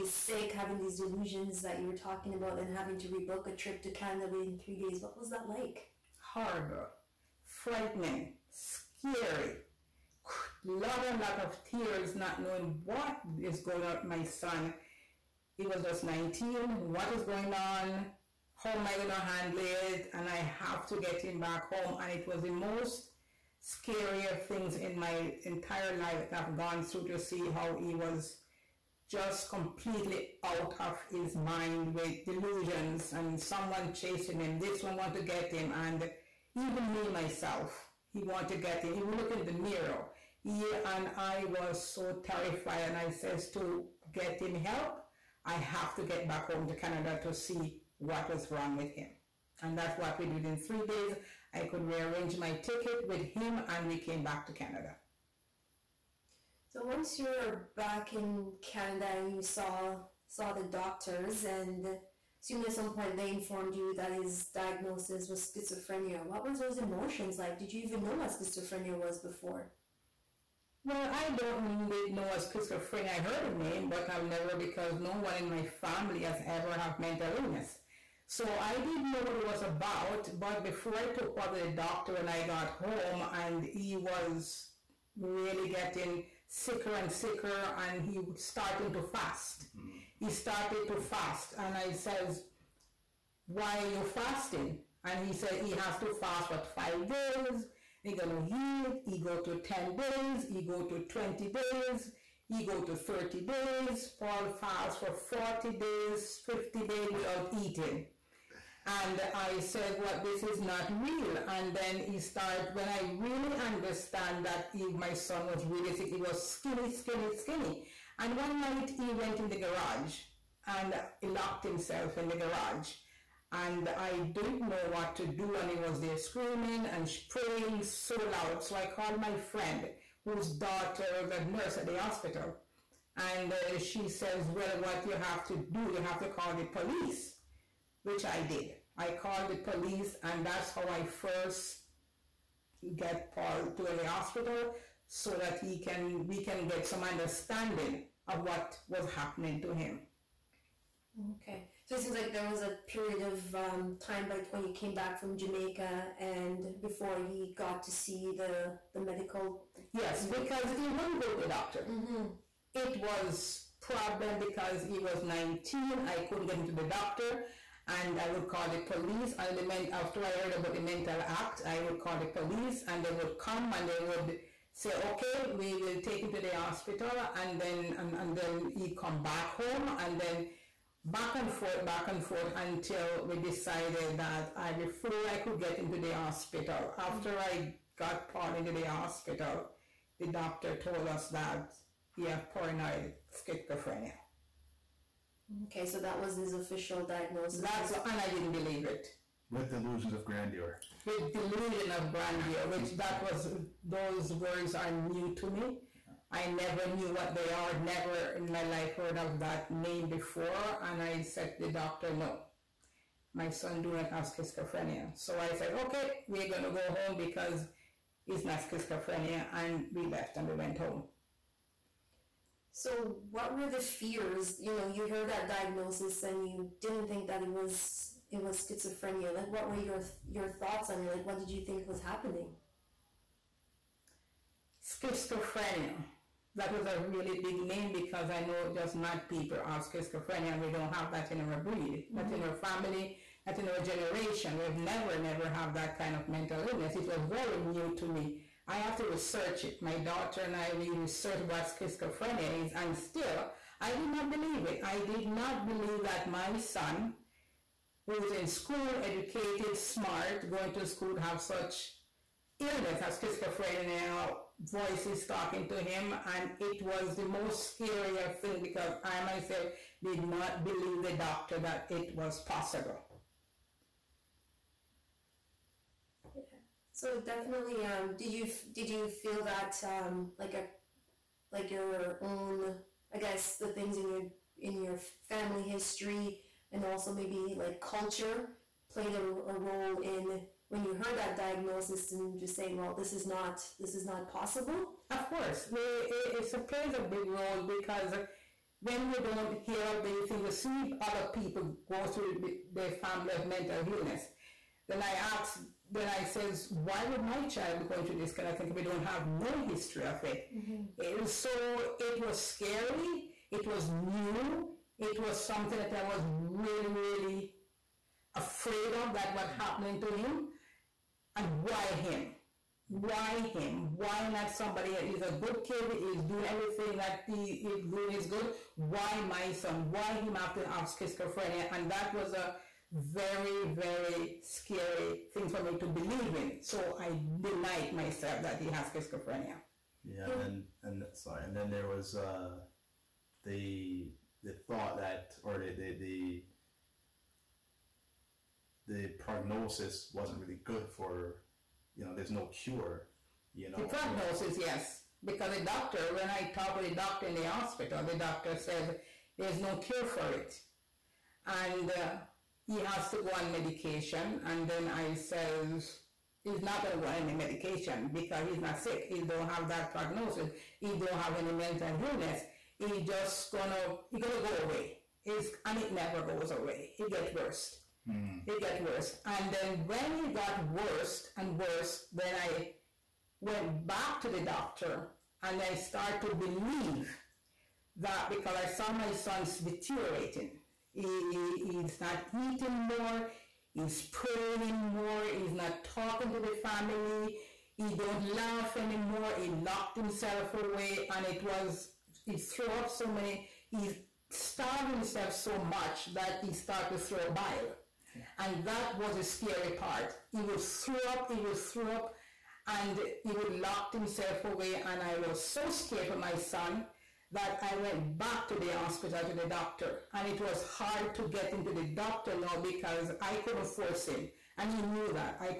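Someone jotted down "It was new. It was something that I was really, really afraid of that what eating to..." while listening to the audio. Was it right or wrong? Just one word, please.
wrong.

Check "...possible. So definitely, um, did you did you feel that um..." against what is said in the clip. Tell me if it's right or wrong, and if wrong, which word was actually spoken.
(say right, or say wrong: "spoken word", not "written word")
right.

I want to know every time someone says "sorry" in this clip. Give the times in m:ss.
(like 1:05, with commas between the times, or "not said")
5:41.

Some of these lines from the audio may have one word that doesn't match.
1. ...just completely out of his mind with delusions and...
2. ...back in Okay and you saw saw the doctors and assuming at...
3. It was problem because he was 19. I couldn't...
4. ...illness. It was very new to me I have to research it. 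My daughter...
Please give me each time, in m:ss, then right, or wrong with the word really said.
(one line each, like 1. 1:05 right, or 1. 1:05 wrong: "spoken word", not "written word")
1. 0:29 right
2. 0:57 wrong: "Canada", not "Okay"
3. 2:42 right
4. 4:06 right.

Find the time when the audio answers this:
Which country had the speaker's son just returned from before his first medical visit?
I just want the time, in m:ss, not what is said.
2:35.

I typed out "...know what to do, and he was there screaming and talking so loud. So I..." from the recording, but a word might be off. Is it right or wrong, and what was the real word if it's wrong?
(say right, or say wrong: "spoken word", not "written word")
wrong: "praying", not "talking".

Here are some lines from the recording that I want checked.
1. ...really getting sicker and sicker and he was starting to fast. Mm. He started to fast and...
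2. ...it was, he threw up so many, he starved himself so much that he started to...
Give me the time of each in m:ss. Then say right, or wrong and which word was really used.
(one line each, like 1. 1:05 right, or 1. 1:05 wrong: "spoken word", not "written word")
1. 1:25 right
2. 6:41 right.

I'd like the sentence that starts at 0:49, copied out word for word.
And that's what we did in three days.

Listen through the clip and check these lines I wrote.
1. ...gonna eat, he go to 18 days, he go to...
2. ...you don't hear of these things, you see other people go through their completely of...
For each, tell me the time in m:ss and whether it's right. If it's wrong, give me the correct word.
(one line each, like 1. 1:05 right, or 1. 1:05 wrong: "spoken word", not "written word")
1. 1:38 wrong: "10", not "18"
2. 4:59 wrong: "family", not "completely".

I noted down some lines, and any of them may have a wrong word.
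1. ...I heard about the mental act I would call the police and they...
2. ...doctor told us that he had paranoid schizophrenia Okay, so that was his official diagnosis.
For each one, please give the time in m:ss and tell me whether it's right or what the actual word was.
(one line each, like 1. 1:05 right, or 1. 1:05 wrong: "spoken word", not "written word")
1. 2:50 right
2. 3:10 right.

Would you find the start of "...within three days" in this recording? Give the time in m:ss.
0:04.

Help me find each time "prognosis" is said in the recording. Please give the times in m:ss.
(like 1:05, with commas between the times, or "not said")
5:49, 5:53, 6:09.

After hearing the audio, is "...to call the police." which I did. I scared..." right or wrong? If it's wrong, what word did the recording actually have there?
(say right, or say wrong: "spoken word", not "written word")
wrong: "called", not "scared".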